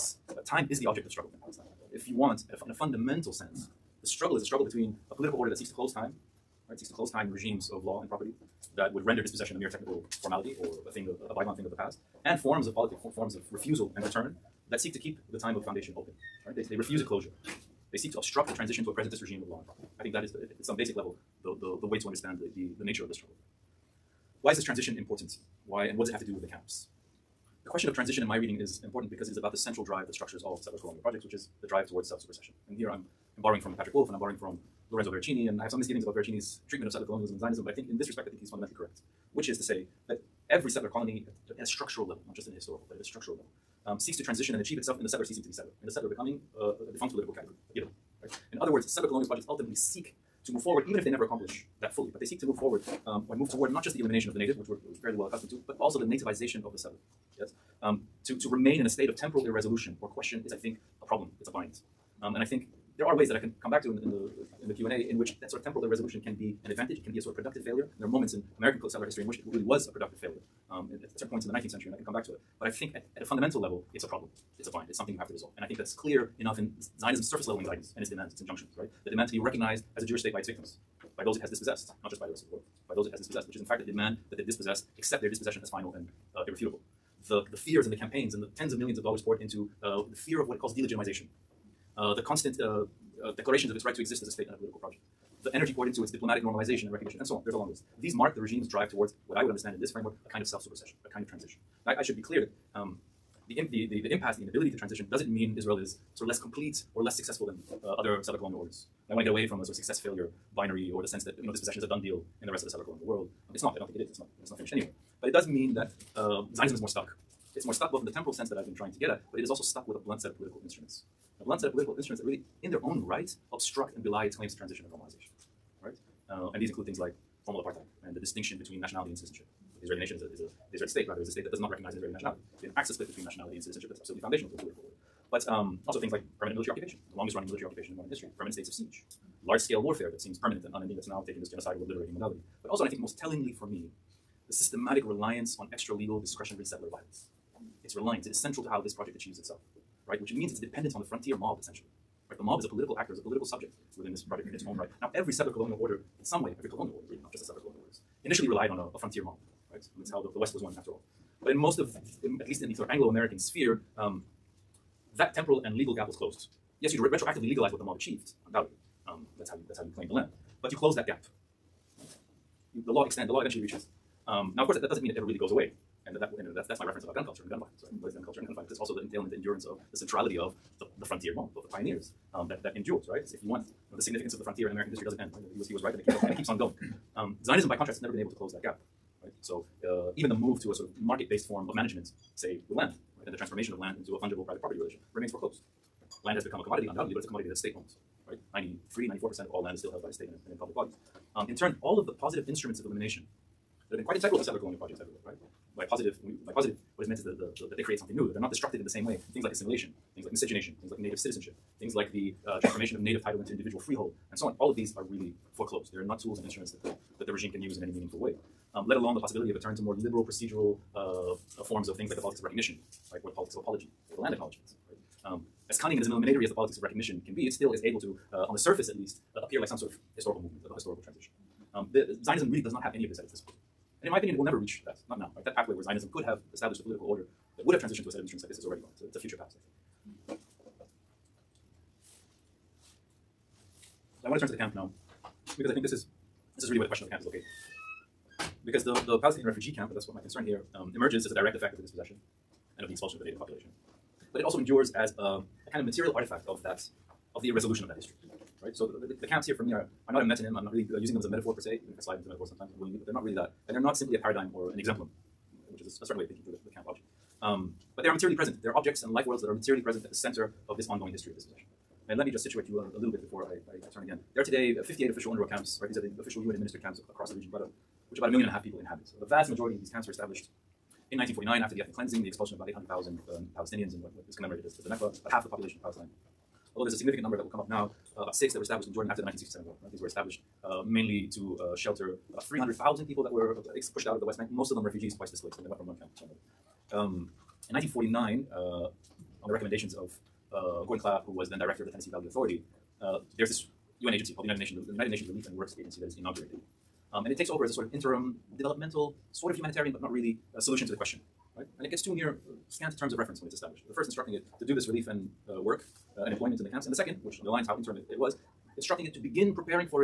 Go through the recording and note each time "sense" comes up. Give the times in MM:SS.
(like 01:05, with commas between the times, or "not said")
00:03, 01:51, 01:58.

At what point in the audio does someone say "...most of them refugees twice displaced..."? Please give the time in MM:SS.
04:54.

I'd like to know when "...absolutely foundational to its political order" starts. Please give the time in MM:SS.
02:14.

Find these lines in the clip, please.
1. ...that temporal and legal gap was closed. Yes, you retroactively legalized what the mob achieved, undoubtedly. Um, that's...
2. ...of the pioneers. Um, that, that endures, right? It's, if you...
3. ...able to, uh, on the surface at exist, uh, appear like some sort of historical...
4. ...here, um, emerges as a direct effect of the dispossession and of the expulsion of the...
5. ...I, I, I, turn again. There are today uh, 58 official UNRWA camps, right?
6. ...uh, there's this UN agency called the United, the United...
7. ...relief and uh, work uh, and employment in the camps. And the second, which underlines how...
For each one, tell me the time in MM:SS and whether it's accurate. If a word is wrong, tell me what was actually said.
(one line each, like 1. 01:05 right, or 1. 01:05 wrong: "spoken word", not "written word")
1. 02:45 right
2. 03:01 right
3. 03:47 wrong: "least", not "exist"
4. 04:10 right
5. 04:33 right
6. 05:03 right
7. 05:14 right.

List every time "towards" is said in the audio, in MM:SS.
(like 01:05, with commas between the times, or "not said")
00:31, 00:53, 01:38.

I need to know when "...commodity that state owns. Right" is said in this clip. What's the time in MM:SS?
03:17.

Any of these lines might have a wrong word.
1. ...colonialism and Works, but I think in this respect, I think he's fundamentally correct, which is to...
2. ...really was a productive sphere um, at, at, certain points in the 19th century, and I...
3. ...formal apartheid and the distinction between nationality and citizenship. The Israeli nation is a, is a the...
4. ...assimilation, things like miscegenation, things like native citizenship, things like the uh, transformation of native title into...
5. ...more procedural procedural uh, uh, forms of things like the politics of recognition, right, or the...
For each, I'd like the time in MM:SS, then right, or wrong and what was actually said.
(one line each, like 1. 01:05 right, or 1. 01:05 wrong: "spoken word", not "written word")
1. 00:37 wrong: "Zionism", not "Works"
2. 01:09 wrong: "failure", not "sphere"
3. 02:07 right
4. 03:29 right
5. 03:39 wrong: "liberal", not "procedural".